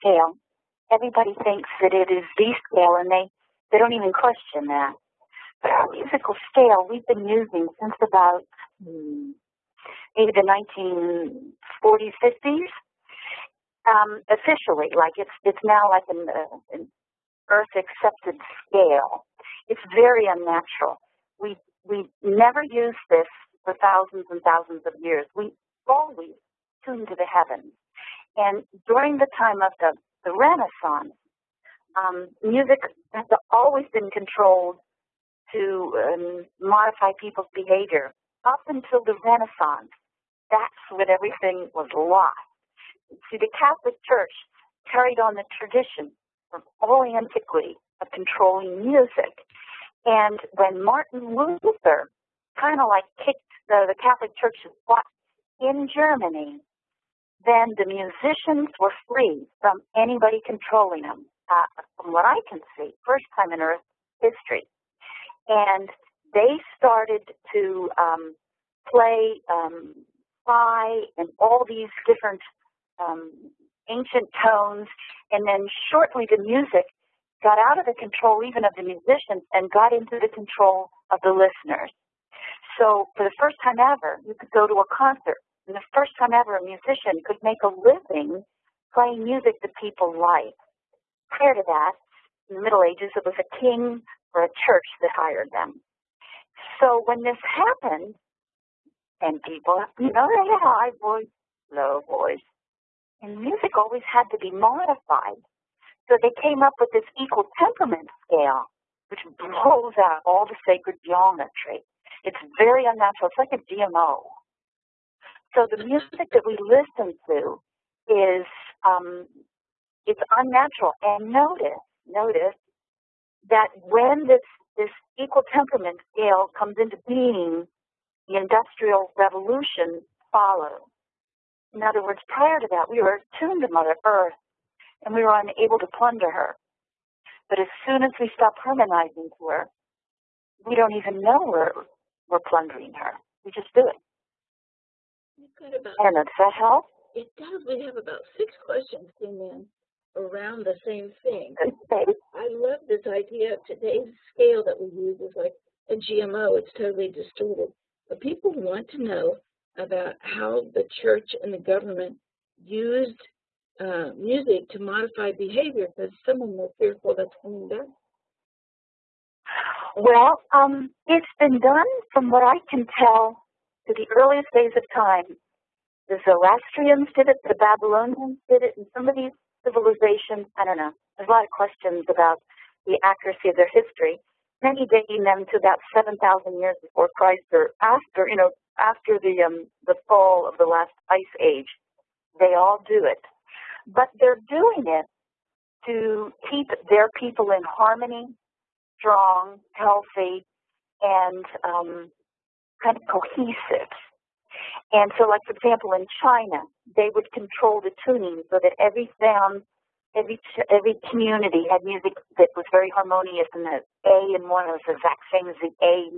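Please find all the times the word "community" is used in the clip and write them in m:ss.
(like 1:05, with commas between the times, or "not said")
3:31.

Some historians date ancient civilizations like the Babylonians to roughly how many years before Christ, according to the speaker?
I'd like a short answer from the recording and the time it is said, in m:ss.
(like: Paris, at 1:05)
7,000, at 3:05.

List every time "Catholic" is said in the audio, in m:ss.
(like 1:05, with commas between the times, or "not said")
0:43, 0:53.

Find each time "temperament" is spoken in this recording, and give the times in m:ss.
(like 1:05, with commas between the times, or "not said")
1:47, 2:05.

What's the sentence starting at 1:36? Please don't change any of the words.
So when this happened, and people, you know, they have high voice, low voice, and music always had to be modified.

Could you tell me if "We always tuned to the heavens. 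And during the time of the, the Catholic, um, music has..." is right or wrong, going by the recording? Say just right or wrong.
wrong.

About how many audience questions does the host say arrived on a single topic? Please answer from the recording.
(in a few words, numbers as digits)
6.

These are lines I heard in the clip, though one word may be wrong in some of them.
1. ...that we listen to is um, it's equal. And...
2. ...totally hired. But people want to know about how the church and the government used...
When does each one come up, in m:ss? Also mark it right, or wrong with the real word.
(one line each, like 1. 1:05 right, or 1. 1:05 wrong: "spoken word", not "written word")
1. 1:56 wrong: "unnatural", not "equal"
2. 2:36 wrong: "distorted", not "hired".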